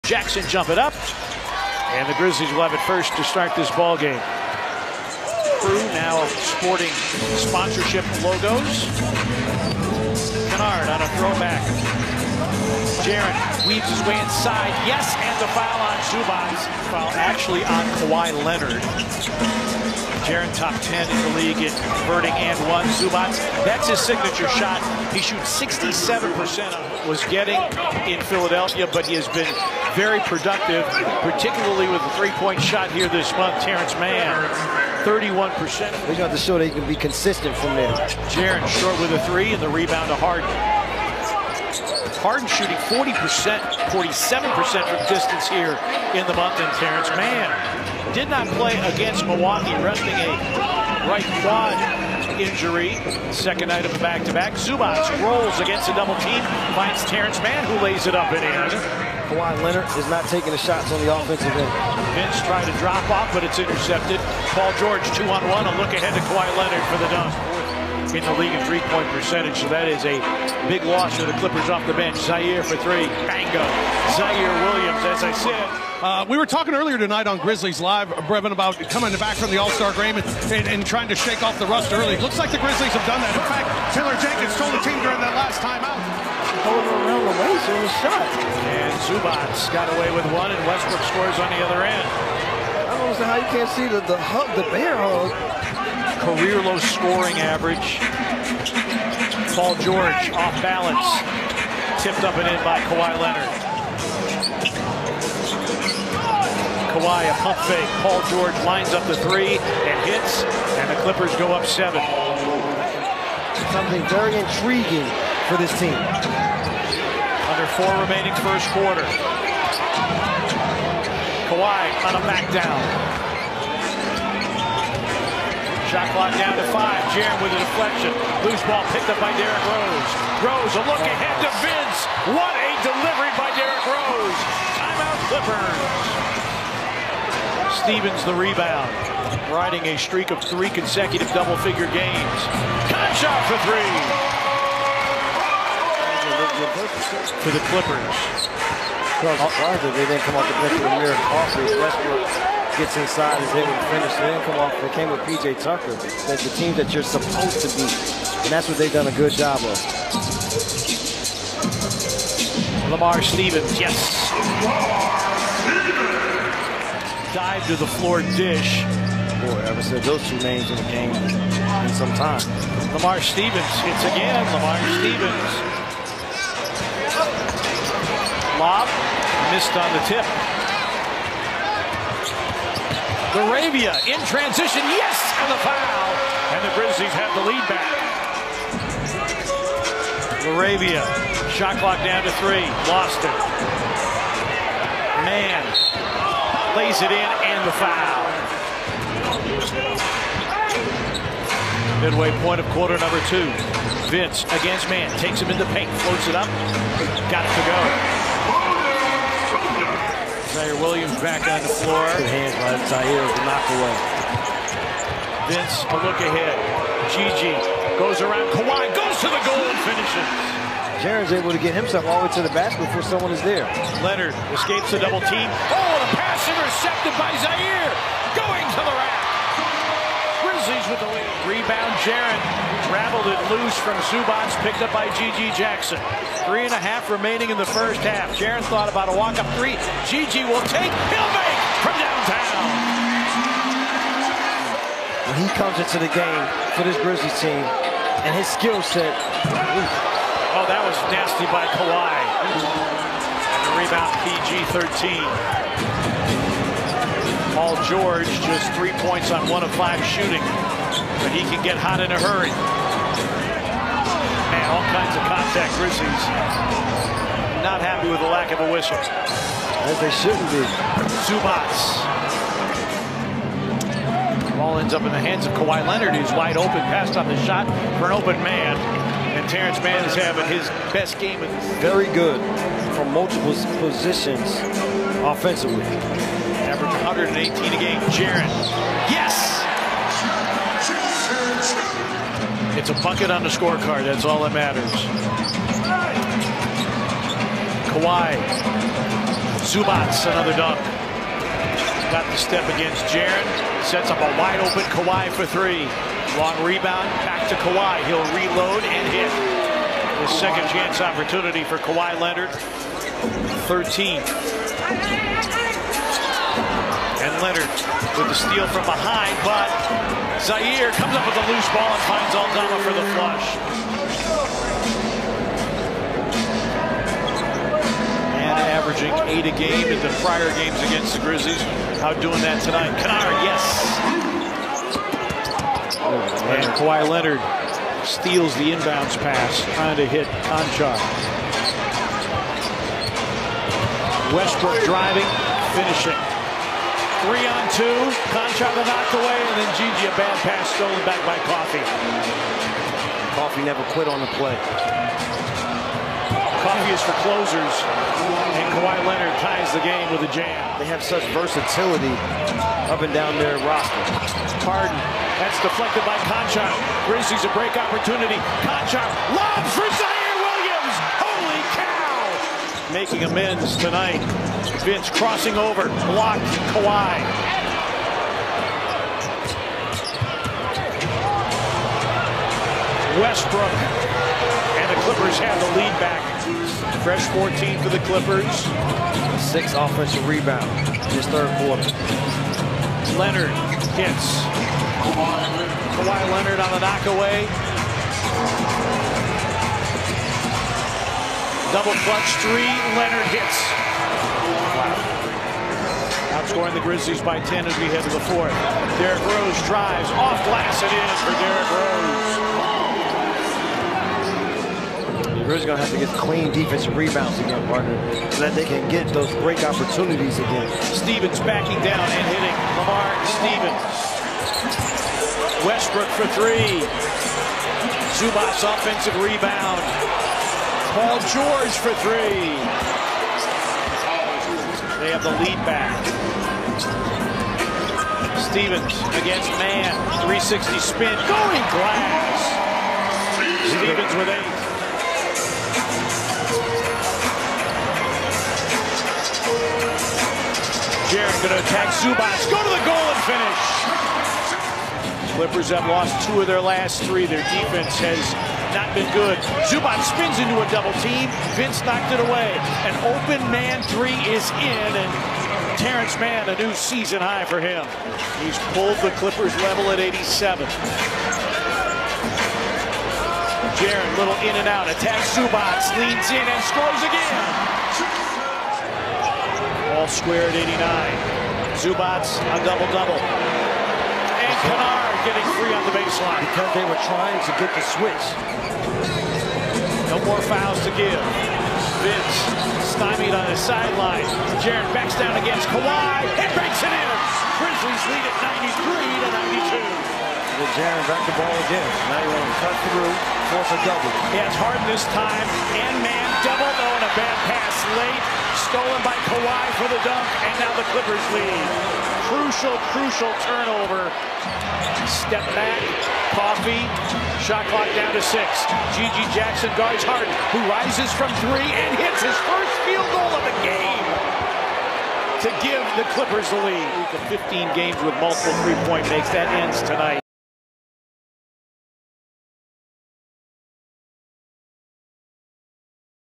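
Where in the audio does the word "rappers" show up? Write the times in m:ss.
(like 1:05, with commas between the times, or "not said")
not said.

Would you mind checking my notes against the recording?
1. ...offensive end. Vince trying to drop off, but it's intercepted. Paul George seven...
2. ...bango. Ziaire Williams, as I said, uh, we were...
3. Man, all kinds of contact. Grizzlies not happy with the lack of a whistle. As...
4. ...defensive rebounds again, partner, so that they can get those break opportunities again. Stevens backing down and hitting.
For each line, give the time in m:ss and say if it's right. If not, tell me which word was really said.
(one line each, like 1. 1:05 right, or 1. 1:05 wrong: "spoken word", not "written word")
1. 1:01 wrong: "two", not "seven"
2. 1:13 right
3. 4:22 right
4. 6:56 right.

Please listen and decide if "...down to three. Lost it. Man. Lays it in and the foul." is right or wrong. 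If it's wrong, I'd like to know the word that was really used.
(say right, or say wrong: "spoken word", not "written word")
right.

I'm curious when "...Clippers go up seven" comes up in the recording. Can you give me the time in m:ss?
1:51.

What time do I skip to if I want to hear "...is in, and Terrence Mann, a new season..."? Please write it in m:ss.
7:44.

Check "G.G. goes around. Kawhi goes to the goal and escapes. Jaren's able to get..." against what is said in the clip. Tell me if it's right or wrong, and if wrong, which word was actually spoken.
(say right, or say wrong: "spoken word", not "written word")
wrong: "finishes", not "escapes".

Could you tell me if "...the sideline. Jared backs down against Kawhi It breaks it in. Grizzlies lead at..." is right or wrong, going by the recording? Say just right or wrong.
right.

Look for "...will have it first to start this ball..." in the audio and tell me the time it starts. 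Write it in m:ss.
0:02.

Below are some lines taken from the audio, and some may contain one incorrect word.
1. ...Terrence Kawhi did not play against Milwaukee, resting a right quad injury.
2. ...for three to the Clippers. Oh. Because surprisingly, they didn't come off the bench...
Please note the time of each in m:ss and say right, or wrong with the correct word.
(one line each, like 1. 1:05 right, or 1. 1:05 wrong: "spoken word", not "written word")
1. 0:46 wrong: "Mann", not "Kawhi"
2. 2:23 right.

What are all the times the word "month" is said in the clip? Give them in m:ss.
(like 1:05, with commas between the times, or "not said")
0:33, 0:46.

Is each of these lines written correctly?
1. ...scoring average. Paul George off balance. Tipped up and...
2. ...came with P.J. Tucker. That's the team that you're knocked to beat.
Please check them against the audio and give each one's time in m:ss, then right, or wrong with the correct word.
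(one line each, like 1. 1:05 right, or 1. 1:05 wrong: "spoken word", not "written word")
1. 1:36 right
2. 2:34 wrong: "supposed", not "knocked".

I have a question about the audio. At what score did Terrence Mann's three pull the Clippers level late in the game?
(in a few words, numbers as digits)
87.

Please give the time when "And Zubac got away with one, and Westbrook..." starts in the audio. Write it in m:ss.
1:28.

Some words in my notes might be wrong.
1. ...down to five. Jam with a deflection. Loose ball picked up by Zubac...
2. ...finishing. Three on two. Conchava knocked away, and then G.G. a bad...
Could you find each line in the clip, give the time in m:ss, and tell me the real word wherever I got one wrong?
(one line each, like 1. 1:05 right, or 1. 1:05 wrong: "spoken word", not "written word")
1. 2:06 wrong: "Derrick", not "Zubac"
2. 5:45 right.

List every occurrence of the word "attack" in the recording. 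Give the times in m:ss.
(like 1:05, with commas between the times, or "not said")
7:31, 7:54.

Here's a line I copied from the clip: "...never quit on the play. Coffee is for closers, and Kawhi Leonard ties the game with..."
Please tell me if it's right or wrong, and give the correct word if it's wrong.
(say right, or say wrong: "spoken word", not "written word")
right.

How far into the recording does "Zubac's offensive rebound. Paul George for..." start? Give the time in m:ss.
7:08.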